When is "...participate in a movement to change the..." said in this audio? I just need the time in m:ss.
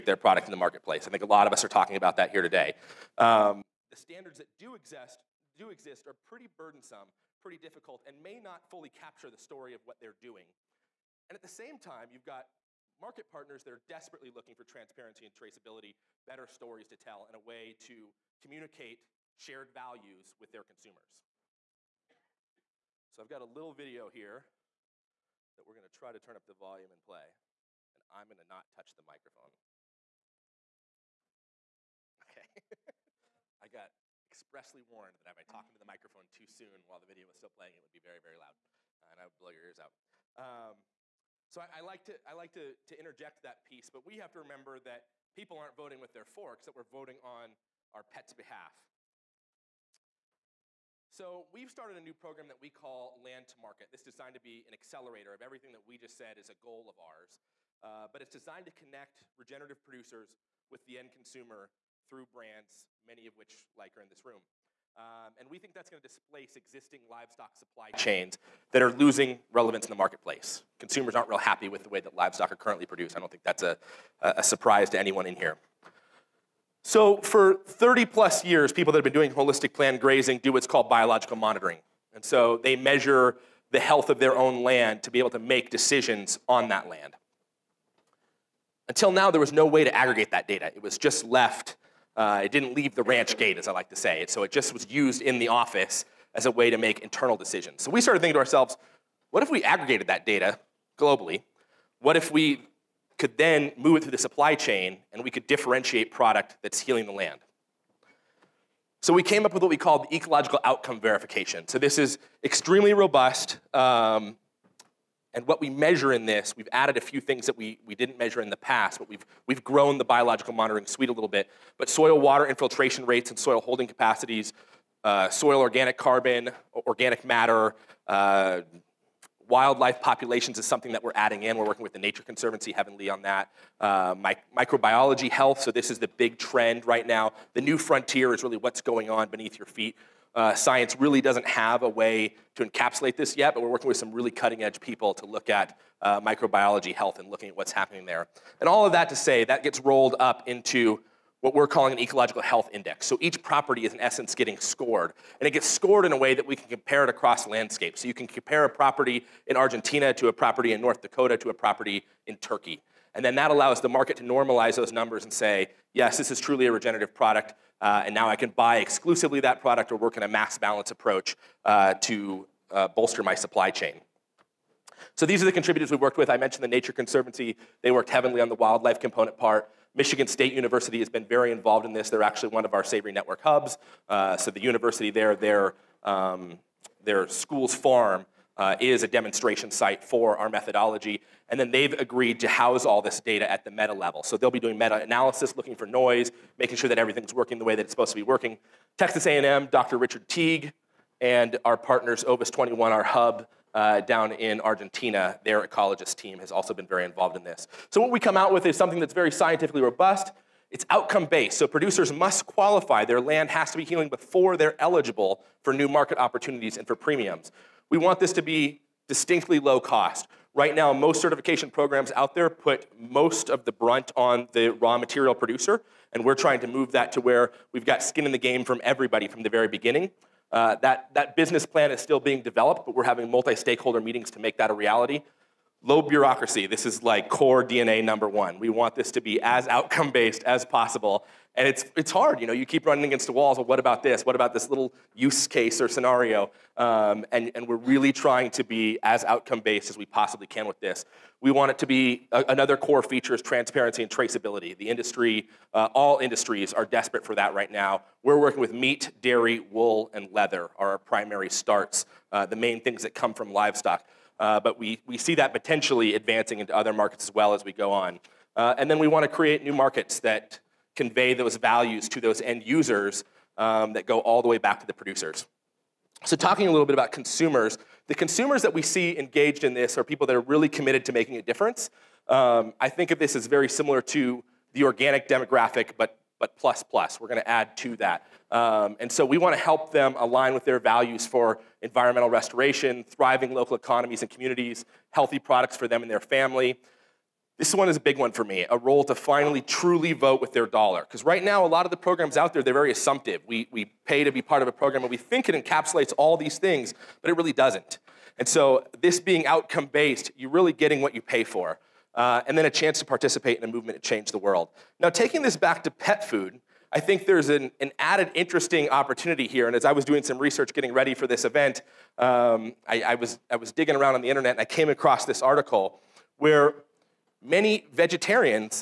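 5:13.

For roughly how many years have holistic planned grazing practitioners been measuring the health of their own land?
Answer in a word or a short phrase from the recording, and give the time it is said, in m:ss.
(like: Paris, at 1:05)
30 plus years, at 1:17.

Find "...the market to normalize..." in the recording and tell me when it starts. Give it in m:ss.
2:43.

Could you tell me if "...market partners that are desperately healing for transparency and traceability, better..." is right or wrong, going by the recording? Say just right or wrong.
wrong.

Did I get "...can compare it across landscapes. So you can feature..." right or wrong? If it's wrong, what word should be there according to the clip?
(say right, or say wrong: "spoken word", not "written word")
wrong: "compare", not "feature".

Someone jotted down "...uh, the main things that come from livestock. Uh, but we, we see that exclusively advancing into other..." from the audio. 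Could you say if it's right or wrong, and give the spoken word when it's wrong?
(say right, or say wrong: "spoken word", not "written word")
wrong: "potentially", not "exclusively".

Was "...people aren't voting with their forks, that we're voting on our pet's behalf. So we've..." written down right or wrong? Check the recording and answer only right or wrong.
right.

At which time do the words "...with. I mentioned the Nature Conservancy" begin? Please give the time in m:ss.
2:56.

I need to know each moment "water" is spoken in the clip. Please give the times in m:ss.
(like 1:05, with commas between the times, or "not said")
2:02.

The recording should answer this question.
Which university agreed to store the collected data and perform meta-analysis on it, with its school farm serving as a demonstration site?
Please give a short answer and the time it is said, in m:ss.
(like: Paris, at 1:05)
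Michigan State University, at 2:59.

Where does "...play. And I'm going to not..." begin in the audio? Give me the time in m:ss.
0:27.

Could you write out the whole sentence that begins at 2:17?
The new frontier is really what's going on beneath your feet.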